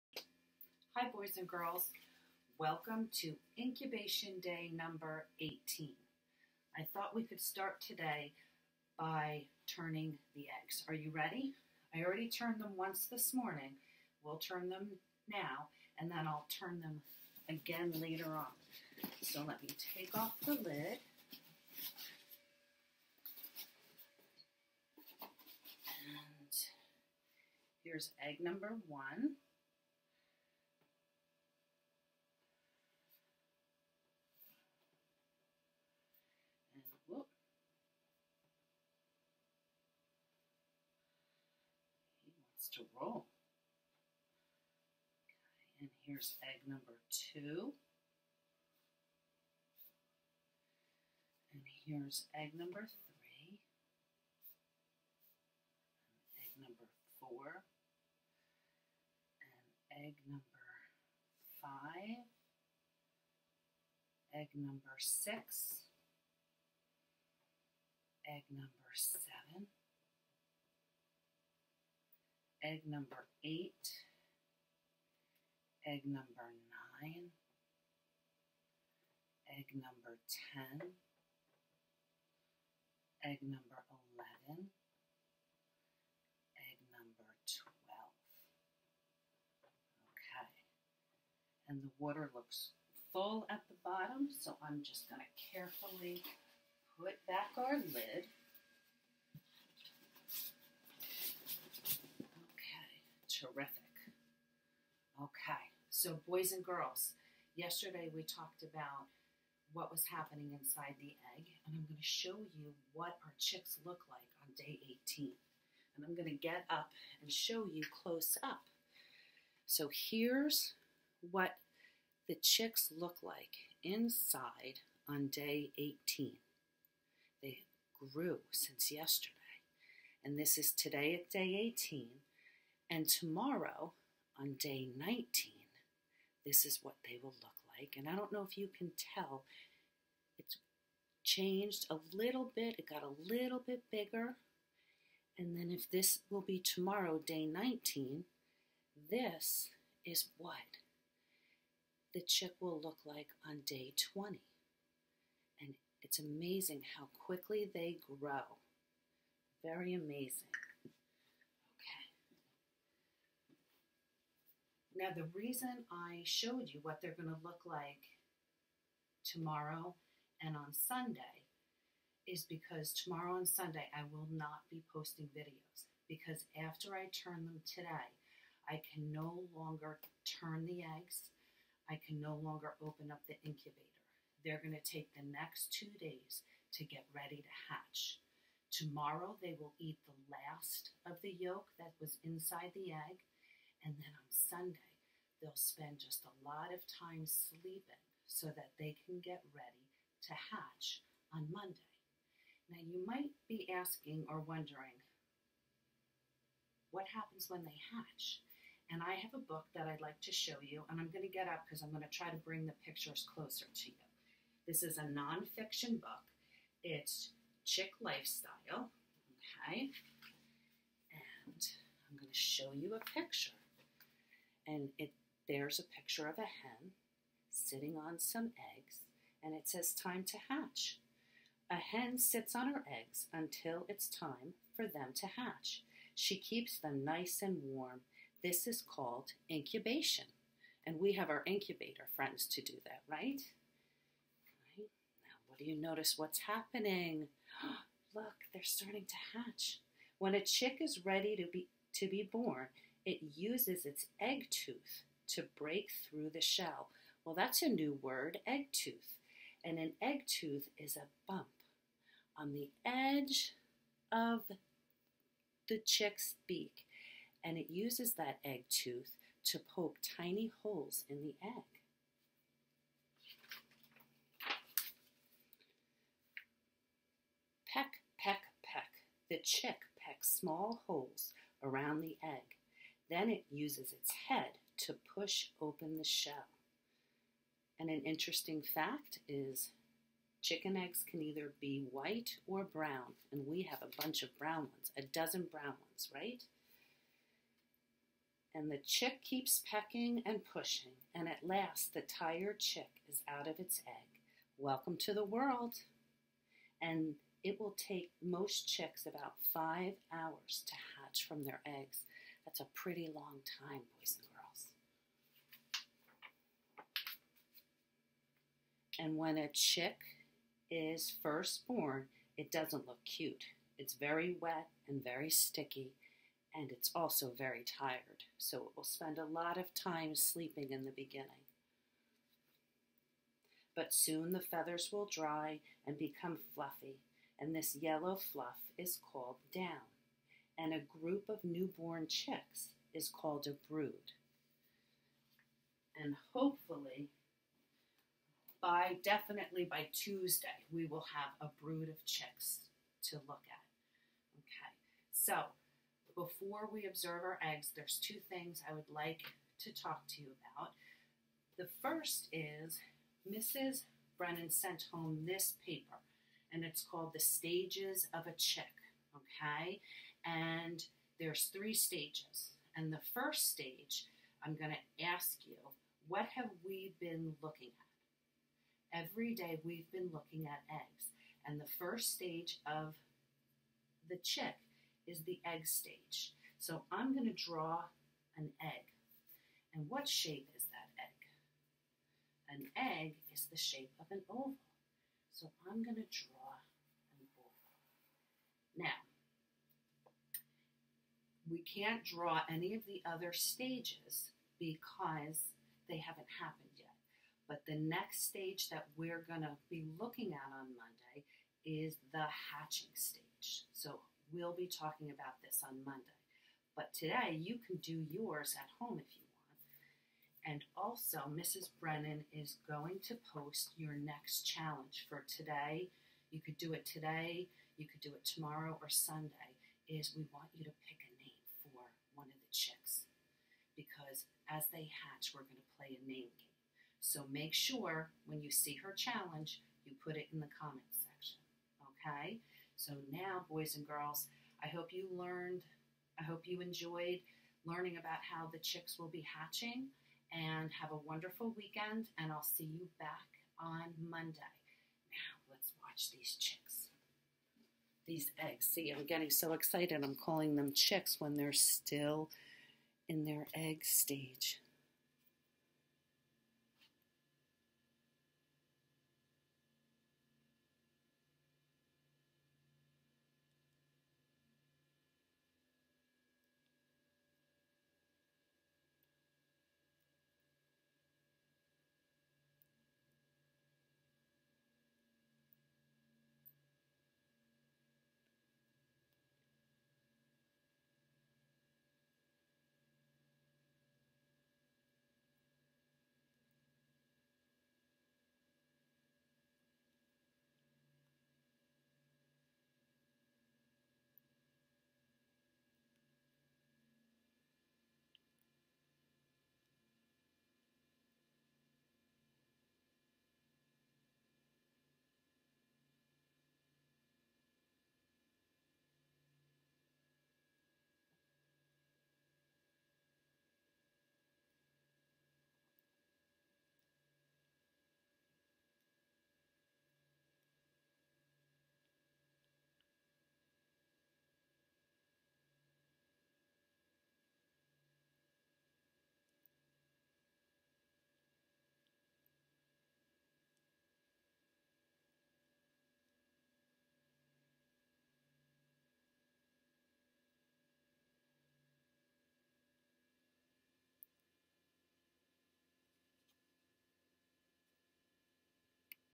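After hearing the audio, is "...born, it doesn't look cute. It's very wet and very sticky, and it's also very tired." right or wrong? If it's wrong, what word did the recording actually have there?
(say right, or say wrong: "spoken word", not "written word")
right.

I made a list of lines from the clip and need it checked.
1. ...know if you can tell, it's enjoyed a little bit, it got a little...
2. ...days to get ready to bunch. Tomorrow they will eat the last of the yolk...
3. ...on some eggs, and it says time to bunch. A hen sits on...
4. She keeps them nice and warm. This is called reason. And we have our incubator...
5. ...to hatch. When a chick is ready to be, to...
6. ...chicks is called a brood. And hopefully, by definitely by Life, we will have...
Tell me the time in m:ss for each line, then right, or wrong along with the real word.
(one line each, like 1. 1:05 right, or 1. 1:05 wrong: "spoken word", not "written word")
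1. 2:18 wrong: "changed", not "enjoyed"
2. 3:05 wrong: "hatch", not "bunch"
3. 3:47 wrong: "hatch", not "bunch"
4. 3:56 wrong: "incubation", not "reason"
5. 4:09 right
6. 5:42 wrong: "Tuesday", not "Life".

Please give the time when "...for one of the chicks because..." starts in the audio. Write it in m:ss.
7:11.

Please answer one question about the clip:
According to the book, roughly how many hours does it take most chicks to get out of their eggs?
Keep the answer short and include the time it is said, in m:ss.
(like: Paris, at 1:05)
5, at 5:09.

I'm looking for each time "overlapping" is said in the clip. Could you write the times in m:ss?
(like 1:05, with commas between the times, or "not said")
not said.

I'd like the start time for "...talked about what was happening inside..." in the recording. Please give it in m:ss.
1:48.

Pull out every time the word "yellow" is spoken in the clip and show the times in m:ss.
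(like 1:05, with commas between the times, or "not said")
5:37.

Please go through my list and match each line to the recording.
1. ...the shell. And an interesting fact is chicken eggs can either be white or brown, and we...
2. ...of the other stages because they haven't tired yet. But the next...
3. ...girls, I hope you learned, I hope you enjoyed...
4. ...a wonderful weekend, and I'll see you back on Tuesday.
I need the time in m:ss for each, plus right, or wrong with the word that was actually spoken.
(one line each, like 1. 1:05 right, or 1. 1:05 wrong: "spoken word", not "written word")
1. 4:45 right
2. 6:42 wrong: "happened", not "tired"
3. 7:23 right
4. 7:30 wrong: "Monday", not "Tuesday".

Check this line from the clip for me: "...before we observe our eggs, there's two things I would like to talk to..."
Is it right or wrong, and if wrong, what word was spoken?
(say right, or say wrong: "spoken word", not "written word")
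right.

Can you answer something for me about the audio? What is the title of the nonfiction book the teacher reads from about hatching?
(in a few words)
Chick Life Cycle.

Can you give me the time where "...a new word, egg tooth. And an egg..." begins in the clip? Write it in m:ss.
4:17.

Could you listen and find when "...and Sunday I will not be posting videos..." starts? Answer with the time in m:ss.
2:53.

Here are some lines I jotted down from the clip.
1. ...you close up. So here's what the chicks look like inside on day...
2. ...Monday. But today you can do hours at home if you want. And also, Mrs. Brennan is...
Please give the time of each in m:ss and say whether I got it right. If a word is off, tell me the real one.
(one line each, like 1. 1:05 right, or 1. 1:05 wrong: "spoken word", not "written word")
1. 1:57 right
2. 6:55 wrong: "yours", not "hours".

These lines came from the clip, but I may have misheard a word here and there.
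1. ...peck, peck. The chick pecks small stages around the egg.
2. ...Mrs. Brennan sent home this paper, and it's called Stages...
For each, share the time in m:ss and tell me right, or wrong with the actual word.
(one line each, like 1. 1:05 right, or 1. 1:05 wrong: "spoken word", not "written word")
1. 4:38 wrong: "holes", not "stages"
2. 6:03 wrong: "The", not "Stages".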